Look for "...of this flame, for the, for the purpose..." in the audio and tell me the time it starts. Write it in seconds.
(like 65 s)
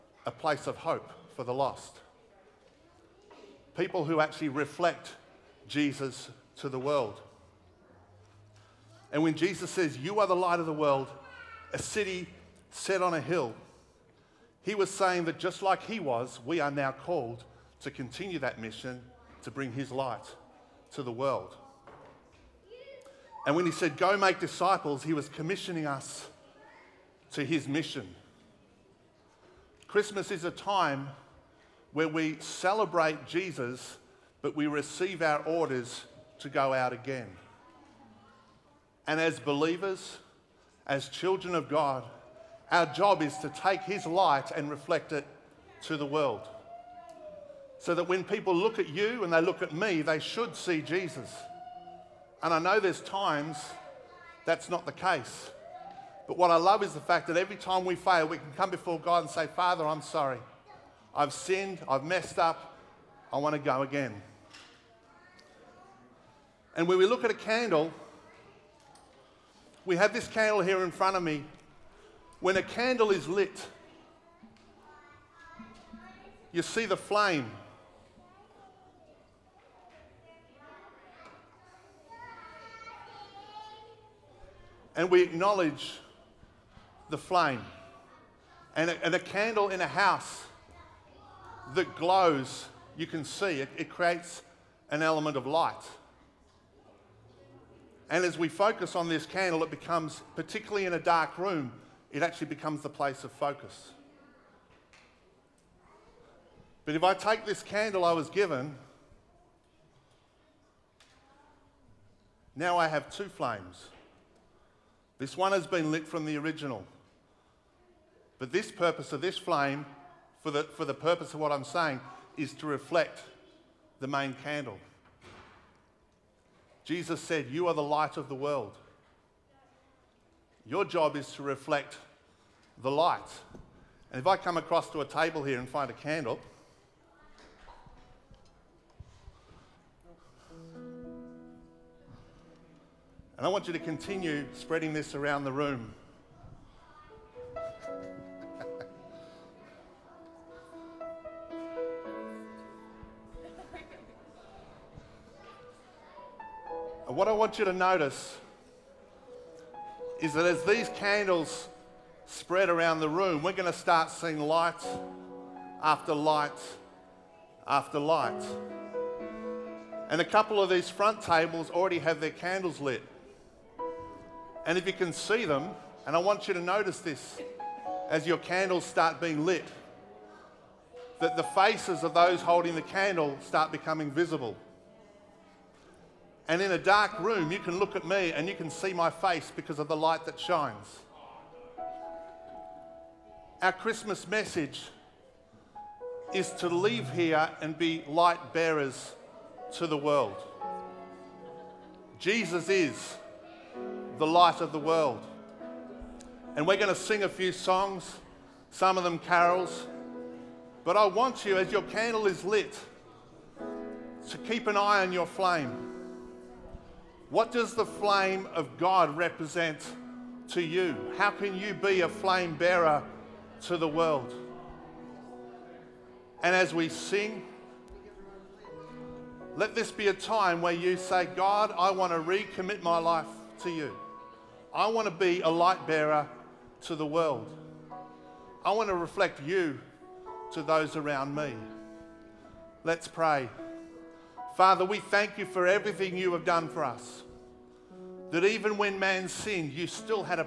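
119 s.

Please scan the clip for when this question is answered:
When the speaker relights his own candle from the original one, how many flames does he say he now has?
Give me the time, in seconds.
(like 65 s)
113 s.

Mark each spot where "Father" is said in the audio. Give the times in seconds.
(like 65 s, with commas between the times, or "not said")
59 s, 244 s.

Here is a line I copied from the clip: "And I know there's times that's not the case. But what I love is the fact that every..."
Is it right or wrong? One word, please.
right.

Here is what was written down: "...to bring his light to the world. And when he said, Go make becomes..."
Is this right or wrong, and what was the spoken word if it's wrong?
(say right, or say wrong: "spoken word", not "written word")
wrong: "disciples", not "becomes".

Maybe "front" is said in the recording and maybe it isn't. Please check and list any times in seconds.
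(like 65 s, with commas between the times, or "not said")
70 s, 170 s.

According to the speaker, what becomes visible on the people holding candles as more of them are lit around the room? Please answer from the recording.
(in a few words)
the faces.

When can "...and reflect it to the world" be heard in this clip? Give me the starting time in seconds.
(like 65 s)
44 s.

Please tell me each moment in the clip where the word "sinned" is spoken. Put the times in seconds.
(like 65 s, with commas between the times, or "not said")
61 s, 249 s.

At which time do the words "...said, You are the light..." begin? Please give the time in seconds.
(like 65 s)
127 s.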